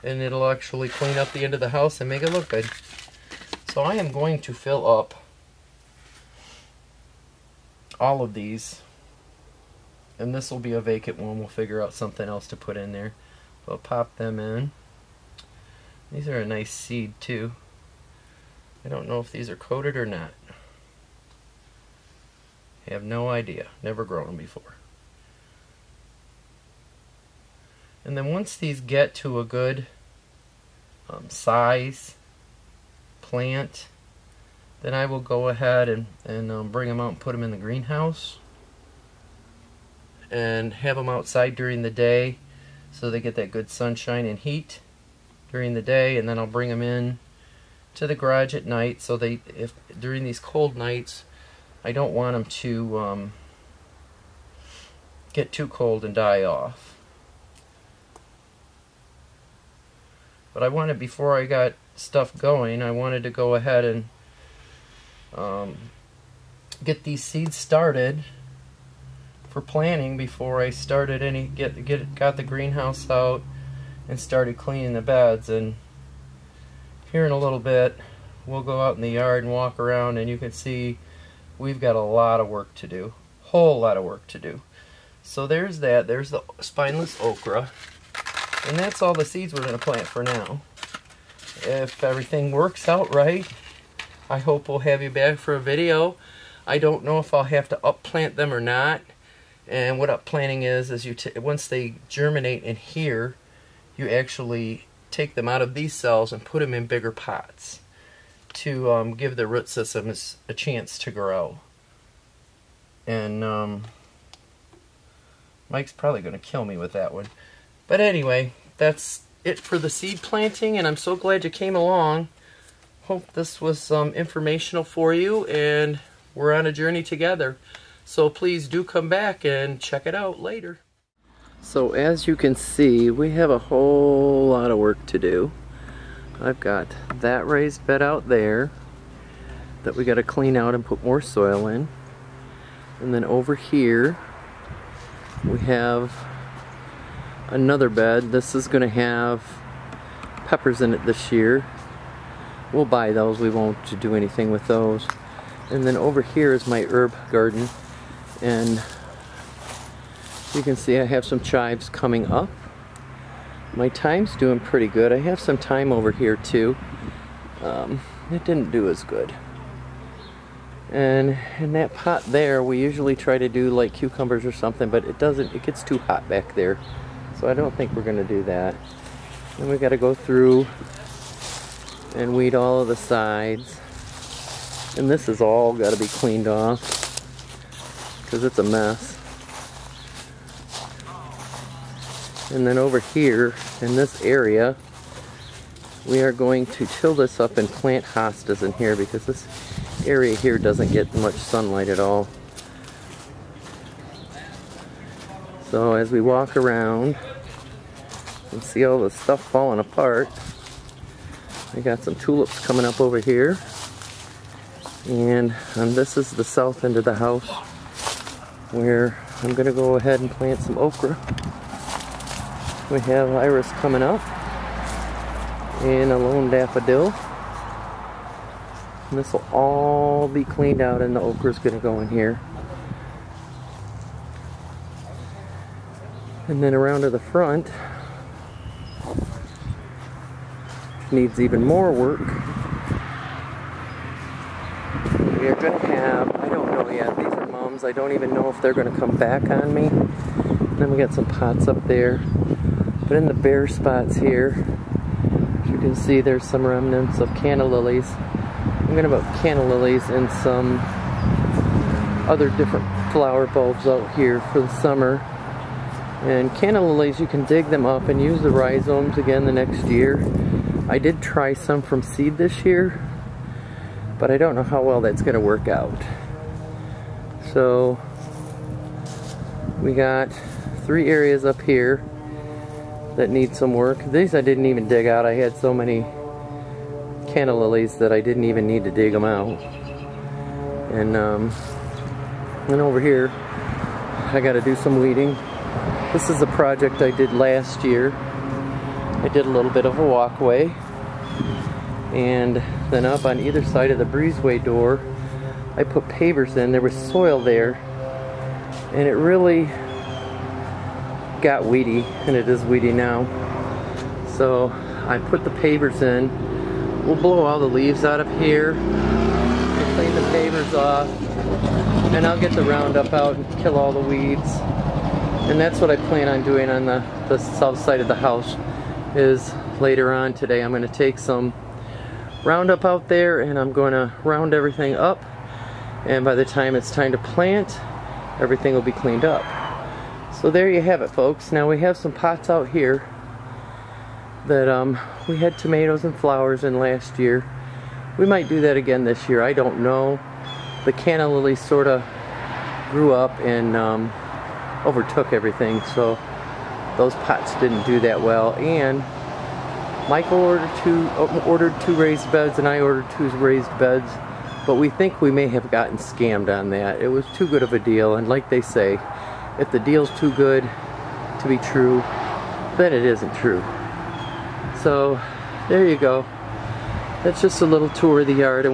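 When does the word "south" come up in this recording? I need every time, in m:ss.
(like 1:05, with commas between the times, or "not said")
3:36, 5:27.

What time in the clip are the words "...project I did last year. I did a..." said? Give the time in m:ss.
4:56.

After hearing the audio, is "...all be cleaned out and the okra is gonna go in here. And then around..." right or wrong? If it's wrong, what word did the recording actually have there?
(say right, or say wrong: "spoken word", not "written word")
right.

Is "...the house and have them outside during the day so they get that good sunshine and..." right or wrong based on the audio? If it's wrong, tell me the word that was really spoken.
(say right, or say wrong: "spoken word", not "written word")
wrong: "greenhouse", not "house".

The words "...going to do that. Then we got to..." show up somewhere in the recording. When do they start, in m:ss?
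2:58.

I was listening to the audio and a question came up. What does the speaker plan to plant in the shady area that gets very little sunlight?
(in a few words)
Hostas.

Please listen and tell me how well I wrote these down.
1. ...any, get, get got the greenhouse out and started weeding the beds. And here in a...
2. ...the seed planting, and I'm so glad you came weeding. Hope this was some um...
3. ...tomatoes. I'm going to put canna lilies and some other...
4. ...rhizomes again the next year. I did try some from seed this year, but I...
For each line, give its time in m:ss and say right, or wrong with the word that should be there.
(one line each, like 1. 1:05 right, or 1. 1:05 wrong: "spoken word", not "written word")
1. 1:11 wrong: "cleaning", not "weeding"
2. 1:59 wrong: "along", not "weeding"
3. 4:17 wrong: "lilies", not "tomatoes"
4. 4:28 right.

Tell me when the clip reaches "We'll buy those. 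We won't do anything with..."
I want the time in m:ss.
2:32.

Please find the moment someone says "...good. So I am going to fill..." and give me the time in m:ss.
0:02.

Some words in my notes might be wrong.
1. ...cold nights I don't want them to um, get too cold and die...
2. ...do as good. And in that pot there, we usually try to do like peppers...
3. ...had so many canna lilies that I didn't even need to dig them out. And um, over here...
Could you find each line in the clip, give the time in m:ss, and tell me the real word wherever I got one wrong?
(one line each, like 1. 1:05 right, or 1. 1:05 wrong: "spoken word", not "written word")
1. 0:50 right
2. 2:48 wrong: "cucumbers", not "peppers"
3. 4:45 right.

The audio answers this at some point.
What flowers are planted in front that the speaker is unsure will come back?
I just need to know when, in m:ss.
4:07.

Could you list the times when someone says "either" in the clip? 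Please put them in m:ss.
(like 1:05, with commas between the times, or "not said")
5:03.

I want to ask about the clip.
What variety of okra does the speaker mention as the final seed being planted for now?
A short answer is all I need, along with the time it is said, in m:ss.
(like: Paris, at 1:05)
Spineless okra, at 1:26.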